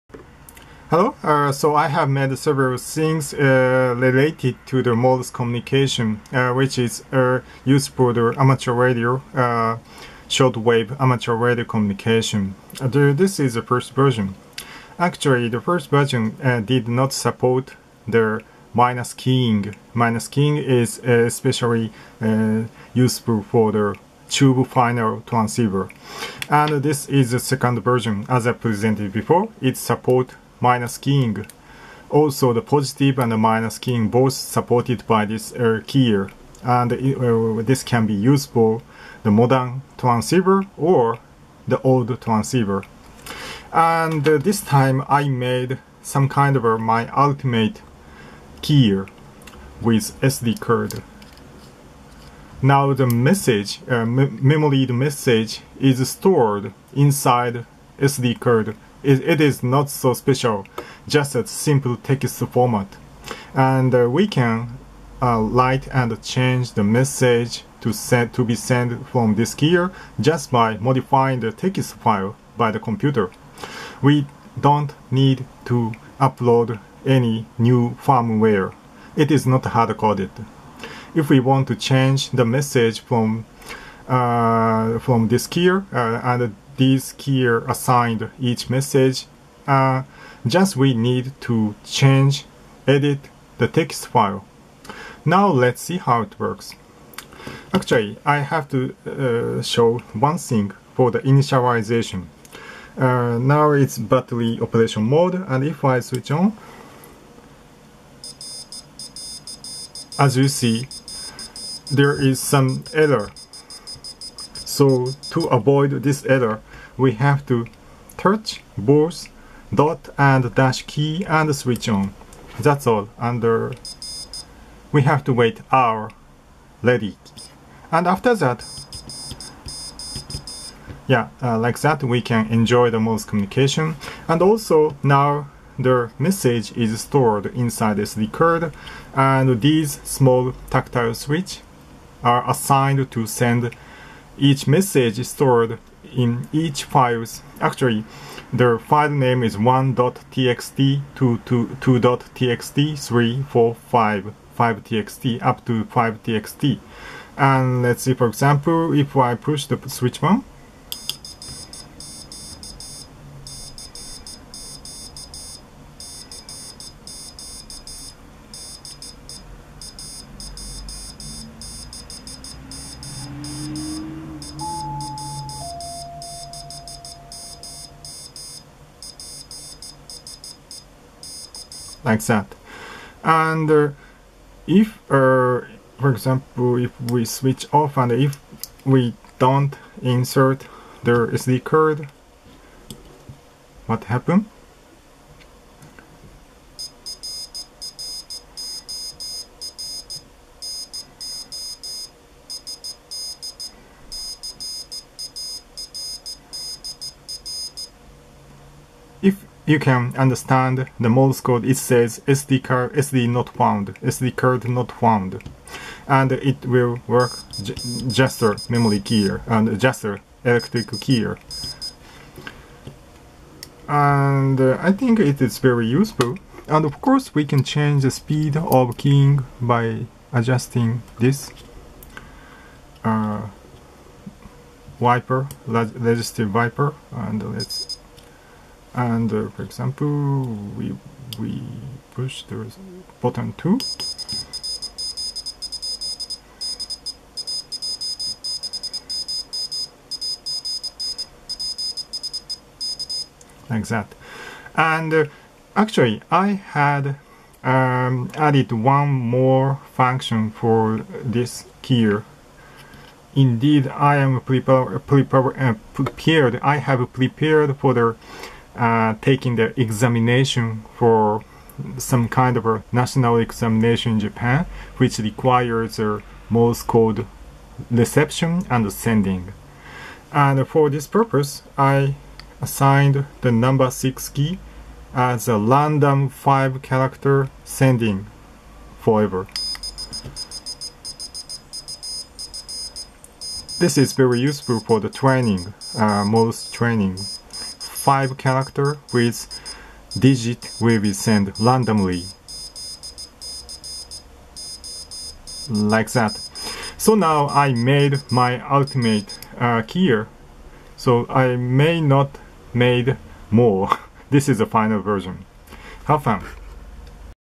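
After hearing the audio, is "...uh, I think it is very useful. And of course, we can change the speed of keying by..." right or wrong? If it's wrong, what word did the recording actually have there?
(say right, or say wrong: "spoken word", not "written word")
right.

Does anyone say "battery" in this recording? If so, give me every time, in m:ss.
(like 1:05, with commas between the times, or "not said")
1:43.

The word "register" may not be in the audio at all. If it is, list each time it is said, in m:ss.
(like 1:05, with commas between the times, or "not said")
3:55.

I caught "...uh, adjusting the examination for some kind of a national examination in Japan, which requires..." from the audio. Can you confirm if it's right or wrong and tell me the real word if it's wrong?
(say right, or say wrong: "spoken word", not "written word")
wrong: "taking", not "adjusting".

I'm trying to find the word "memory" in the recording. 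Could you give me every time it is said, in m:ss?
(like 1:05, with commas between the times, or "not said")
0:54, 3:38.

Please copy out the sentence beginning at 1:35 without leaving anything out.
Now let's see how it works.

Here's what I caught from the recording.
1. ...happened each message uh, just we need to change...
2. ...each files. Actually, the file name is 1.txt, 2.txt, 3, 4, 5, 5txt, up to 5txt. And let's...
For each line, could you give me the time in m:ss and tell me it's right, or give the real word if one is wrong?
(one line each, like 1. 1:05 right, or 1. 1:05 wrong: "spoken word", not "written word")
1. 1:27 wrong: "assigned", not "happened"
2. 2:26 right.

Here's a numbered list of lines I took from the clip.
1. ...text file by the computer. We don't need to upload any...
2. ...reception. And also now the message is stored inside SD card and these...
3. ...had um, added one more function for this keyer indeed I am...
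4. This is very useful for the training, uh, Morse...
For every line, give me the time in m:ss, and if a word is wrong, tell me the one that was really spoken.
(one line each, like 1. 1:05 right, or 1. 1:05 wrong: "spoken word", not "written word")
1. 1:11 right
2. 2:13 wrong: "communication", not "reception"
3. 4:16 right
4. 4:53 right.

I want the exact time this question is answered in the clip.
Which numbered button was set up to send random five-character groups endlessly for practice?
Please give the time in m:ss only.
4:43.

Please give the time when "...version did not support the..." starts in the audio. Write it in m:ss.
0:15.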